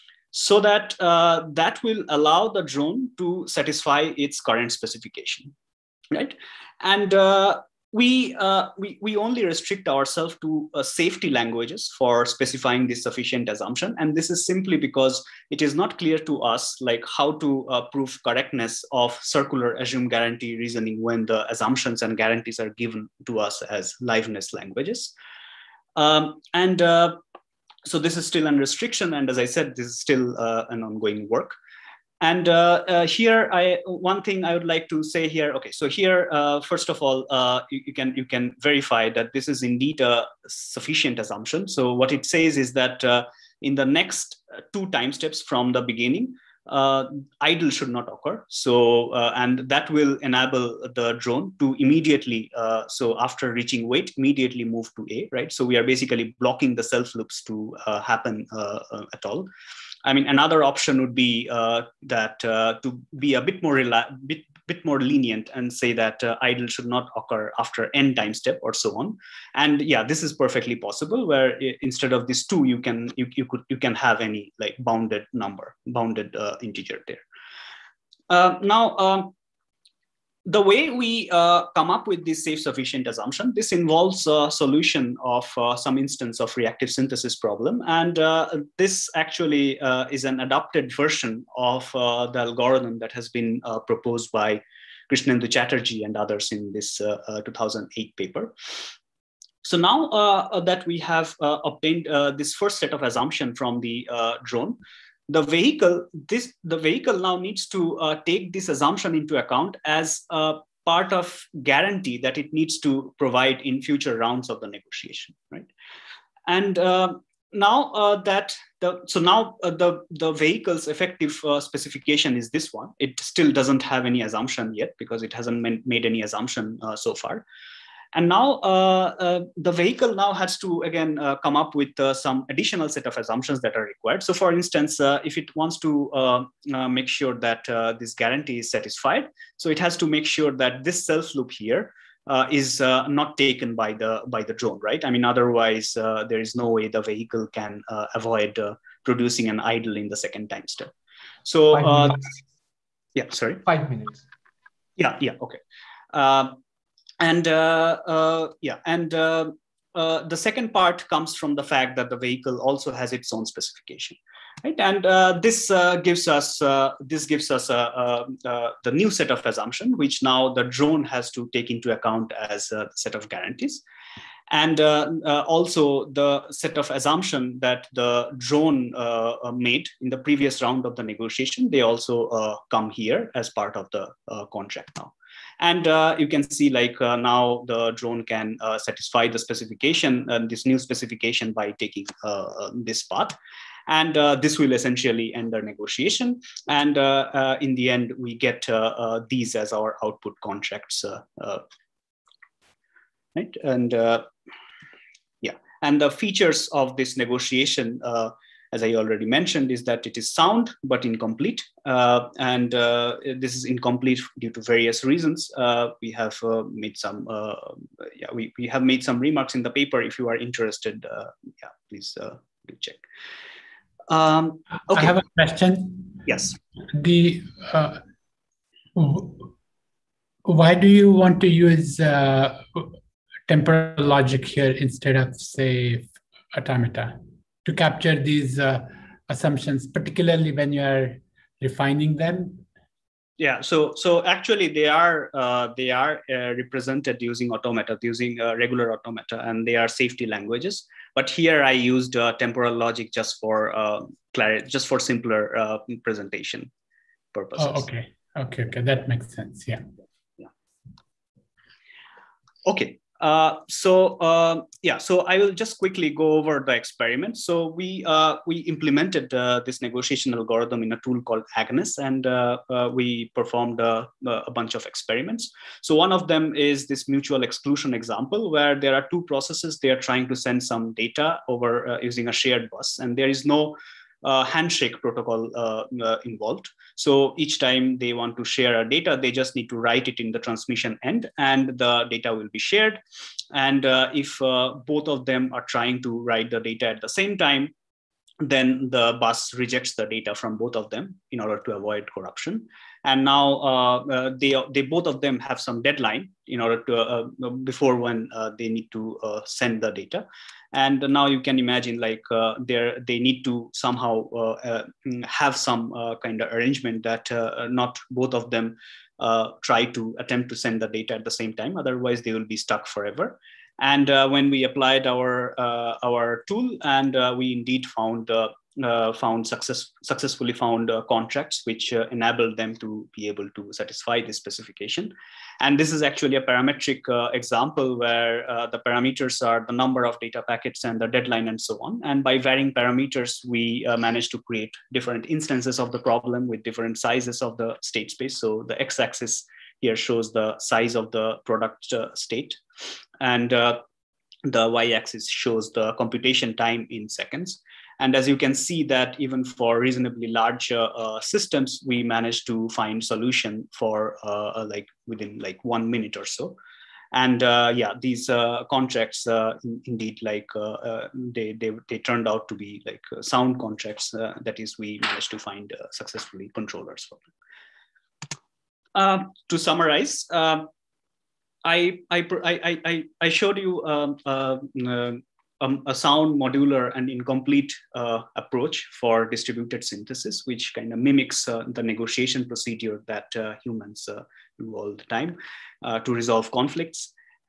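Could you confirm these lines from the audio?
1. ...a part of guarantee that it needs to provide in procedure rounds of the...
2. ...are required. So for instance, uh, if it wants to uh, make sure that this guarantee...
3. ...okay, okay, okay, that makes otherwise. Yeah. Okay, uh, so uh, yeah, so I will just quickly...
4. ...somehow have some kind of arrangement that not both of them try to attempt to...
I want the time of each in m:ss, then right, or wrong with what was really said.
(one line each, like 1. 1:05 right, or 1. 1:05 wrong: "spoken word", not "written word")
1. 1:50 wrong: "future", not "procedure"
2. 2:13 right
3. 4:17 wrong: "sense", not "otherwise"
4. 5:13 right.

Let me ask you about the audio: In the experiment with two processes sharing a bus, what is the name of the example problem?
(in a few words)
Mutual exclusion.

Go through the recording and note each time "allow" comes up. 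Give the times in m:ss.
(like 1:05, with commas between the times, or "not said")
0:02.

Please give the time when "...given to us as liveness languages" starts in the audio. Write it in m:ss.
0:22.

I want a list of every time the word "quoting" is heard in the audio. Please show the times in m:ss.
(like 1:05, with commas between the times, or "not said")
not said.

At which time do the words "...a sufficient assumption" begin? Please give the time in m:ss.
0:40.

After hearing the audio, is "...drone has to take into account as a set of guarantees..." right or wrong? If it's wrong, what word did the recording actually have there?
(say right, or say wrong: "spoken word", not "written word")
right.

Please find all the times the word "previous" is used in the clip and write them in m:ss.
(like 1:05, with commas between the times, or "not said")
3:00.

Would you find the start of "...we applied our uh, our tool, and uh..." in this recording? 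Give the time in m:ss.
5:24.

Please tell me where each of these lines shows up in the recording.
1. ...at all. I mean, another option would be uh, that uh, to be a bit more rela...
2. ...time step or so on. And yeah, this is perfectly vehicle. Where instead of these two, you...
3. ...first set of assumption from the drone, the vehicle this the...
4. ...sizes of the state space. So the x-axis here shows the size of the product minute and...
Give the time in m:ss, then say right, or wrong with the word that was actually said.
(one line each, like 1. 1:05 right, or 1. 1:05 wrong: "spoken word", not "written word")
1. 0:59 right
2. 1:08 wrong: "possible", not "vehicle"
3. 1:42 right
4. 5:46 wrong: "state", not "minute".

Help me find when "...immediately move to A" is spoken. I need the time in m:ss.
0:54.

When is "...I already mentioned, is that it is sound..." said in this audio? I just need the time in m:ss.
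3:28.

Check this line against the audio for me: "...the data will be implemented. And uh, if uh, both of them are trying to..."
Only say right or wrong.
wrong.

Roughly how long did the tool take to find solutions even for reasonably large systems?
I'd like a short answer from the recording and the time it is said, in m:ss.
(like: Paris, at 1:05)
One minute, at 6:05.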